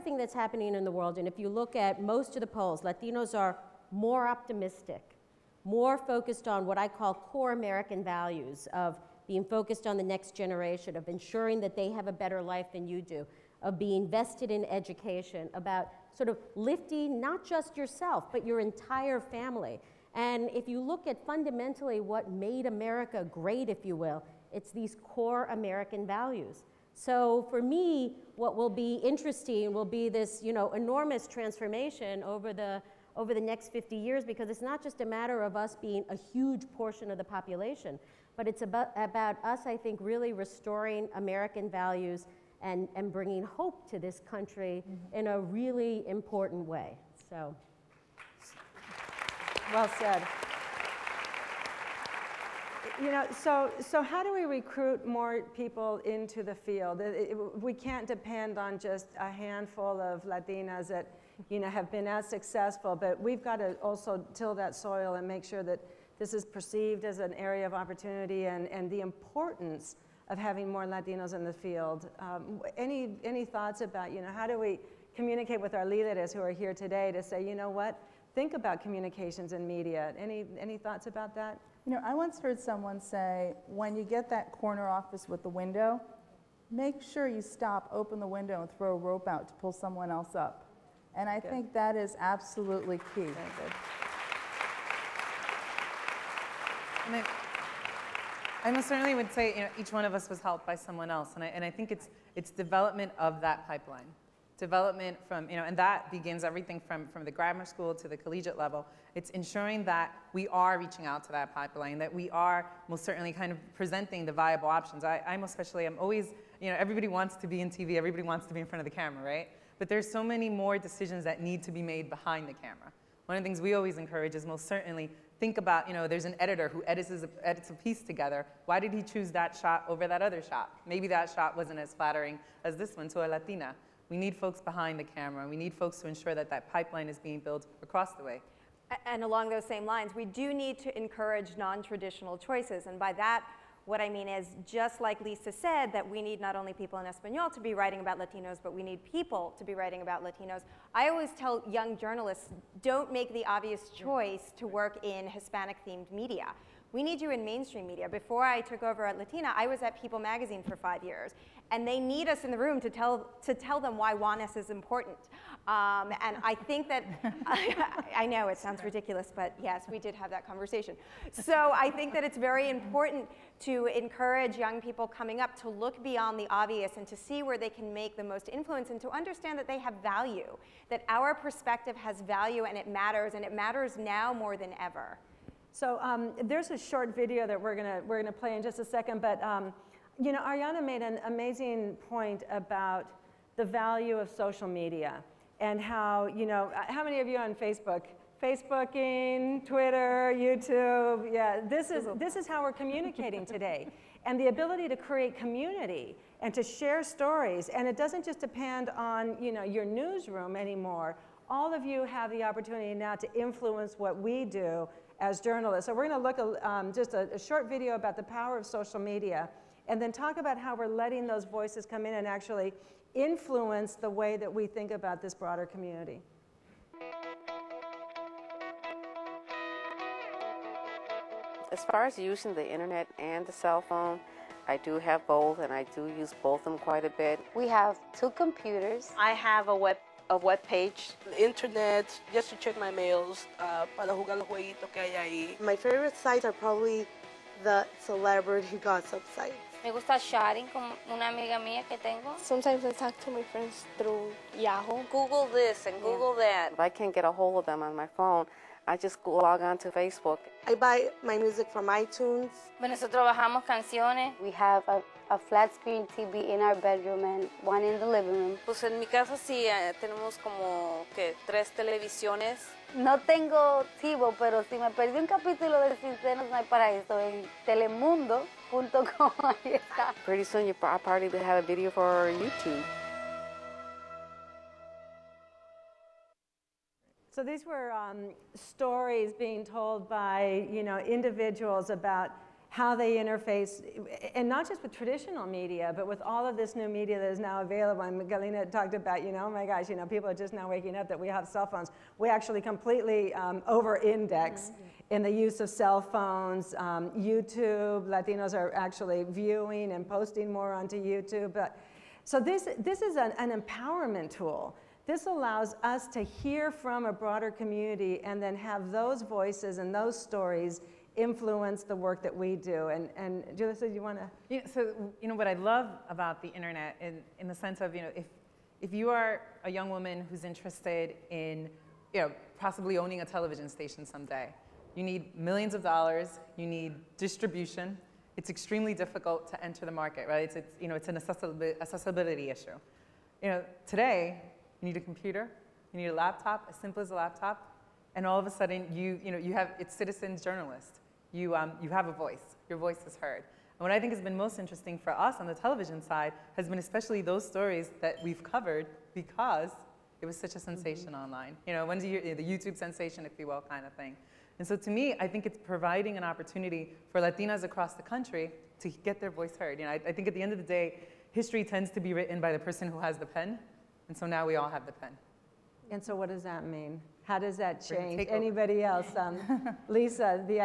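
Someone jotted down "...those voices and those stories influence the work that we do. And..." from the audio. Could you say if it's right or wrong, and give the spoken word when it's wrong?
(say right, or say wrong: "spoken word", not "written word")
right.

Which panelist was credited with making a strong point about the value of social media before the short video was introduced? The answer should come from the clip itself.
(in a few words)
Arianna.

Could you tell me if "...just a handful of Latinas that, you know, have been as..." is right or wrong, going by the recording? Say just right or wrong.
right.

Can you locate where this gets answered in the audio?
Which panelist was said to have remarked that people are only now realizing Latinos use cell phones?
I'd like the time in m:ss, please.
4:58.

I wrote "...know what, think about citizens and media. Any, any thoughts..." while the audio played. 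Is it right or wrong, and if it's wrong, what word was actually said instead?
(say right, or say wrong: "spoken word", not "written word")
wrong: "communications", not "citizens".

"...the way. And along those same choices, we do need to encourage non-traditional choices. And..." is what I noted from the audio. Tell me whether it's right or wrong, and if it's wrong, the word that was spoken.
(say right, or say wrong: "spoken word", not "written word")
wrong: "lines", not "choices".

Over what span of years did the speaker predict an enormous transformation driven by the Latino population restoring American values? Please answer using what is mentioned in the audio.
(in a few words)
50 years.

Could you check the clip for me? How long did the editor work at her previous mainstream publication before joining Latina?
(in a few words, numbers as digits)
5 years.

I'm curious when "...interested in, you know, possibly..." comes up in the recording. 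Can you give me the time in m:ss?
5:30.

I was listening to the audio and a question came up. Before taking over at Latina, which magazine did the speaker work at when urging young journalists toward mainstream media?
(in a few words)
People Magazine.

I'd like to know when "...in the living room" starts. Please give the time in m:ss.
4:27.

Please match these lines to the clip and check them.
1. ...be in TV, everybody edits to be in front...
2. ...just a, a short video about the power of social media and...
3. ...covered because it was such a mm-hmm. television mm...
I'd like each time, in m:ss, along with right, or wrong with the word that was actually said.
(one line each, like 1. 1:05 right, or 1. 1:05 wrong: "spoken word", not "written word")
1. 1:57 wrong: "wants", not "edits"
2. 3:36 right
3. 5:58 wrong: "sensation", not "television".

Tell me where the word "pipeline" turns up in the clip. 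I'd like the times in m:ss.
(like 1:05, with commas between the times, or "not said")
1:43, 1:51, 2:16.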